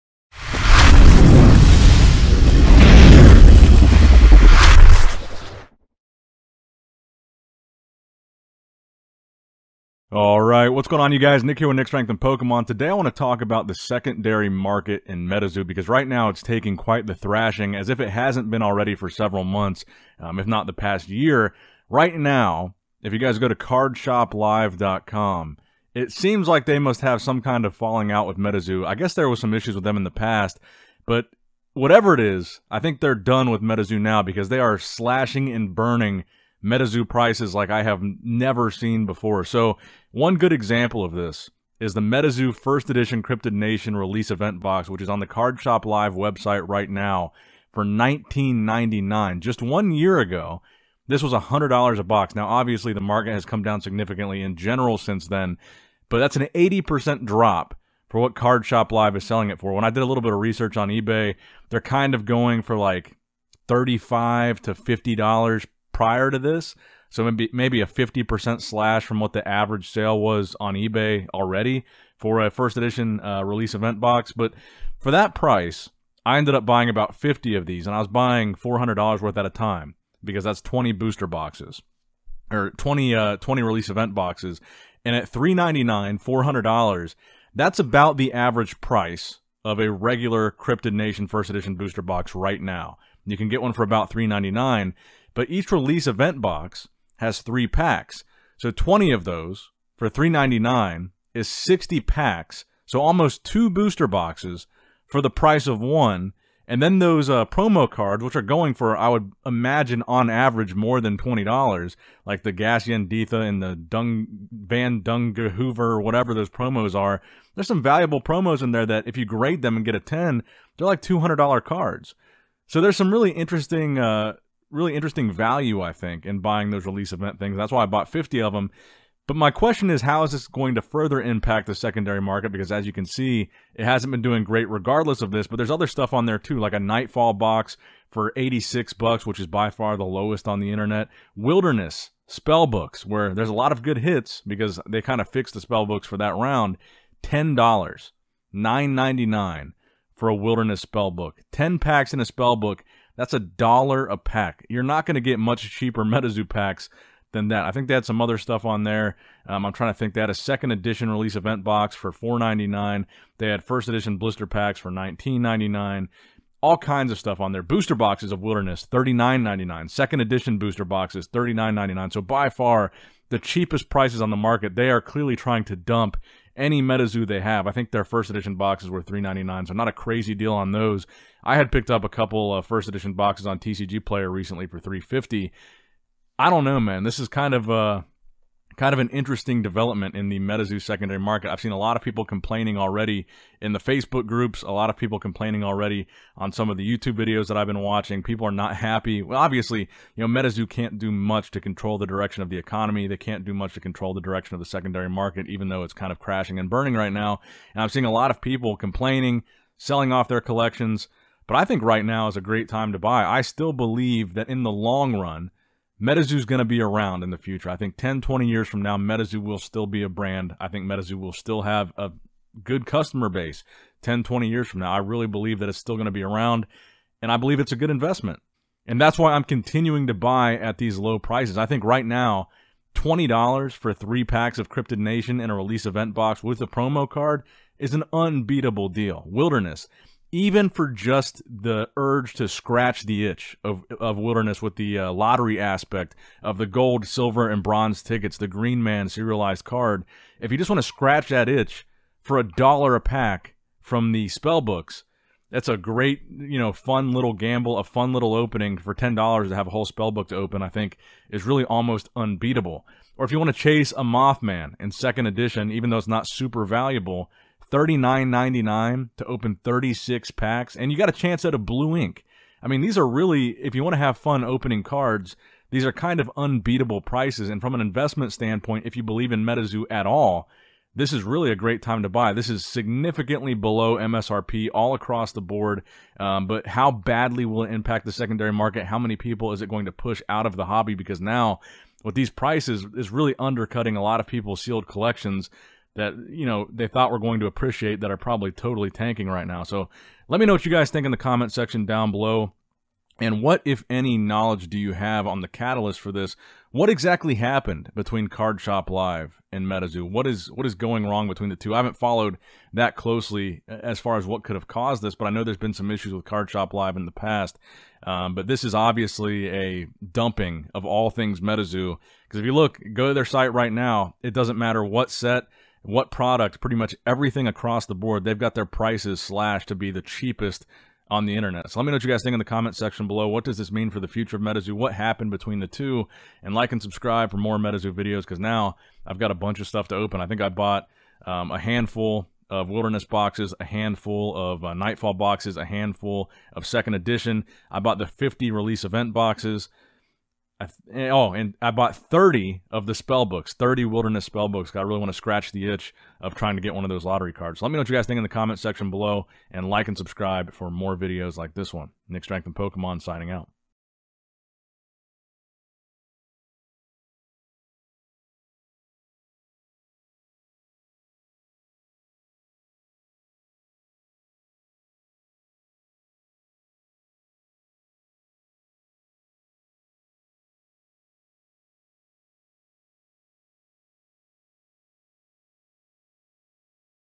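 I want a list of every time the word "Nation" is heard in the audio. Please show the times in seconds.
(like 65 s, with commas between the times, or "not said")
43 s, 90 s, 234 s.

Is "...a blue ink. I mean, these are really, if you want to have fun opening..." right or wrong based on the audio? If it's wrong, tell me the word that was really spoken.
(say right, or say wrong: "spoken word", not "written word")
right.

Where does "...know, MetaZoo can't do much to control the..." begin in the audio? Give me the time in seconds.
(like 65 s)
200 s.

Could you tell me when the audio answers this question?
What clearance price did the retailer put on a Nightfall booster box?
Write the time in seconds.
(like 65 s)
138 s.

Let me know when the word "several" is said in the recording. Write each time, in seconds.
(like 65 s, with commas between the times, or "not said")
19 s.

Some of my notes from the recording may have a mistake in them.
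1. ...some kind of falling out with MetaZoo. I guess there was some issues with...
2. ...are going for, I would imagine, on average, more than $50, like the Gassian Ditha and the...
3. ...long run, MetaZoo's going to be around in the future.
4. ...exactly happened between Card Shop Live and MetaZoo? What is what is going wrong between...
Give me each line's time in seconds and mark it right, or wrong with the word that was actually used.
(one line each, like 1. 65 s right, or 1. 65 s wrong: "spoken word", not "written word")
1. 27 s right
2. 108 s wrong: "20", not "50"
3. 214 s right
4. 306 s right.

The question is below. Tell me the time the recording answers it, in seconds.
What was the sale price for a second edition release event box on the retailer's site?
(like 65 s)
162 s.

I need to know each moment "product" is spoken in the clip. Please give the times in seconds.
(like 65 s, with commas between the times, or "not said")
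326 s.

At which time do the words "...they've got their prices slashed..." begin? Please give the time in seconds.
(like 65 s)
328 s.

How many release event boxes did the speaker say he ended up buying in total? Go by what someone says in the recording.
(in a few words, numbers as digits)
50.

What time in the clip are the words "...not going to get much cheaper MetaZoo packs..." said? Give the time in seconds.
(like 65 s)
154 s.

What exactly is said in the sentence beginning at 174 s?
They are clearly trying to dump any MetaZoo they have.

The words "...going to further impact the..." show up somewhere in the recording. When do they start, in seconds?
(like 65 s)
130 s.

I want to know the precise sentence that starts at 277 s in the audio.
And from an investment standpoint, if you believe in MetaZoo at all, this is really a great time to buy.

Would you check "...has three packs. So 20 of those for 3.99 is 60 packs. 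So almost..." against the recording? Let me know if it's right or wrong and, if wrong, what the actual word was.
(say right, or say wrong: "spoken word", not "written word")
right.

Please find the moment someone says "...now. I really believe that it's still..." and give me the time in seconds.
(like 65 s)
224 s.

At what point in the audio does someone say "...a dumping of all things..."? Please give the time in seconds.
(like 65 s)
319 s.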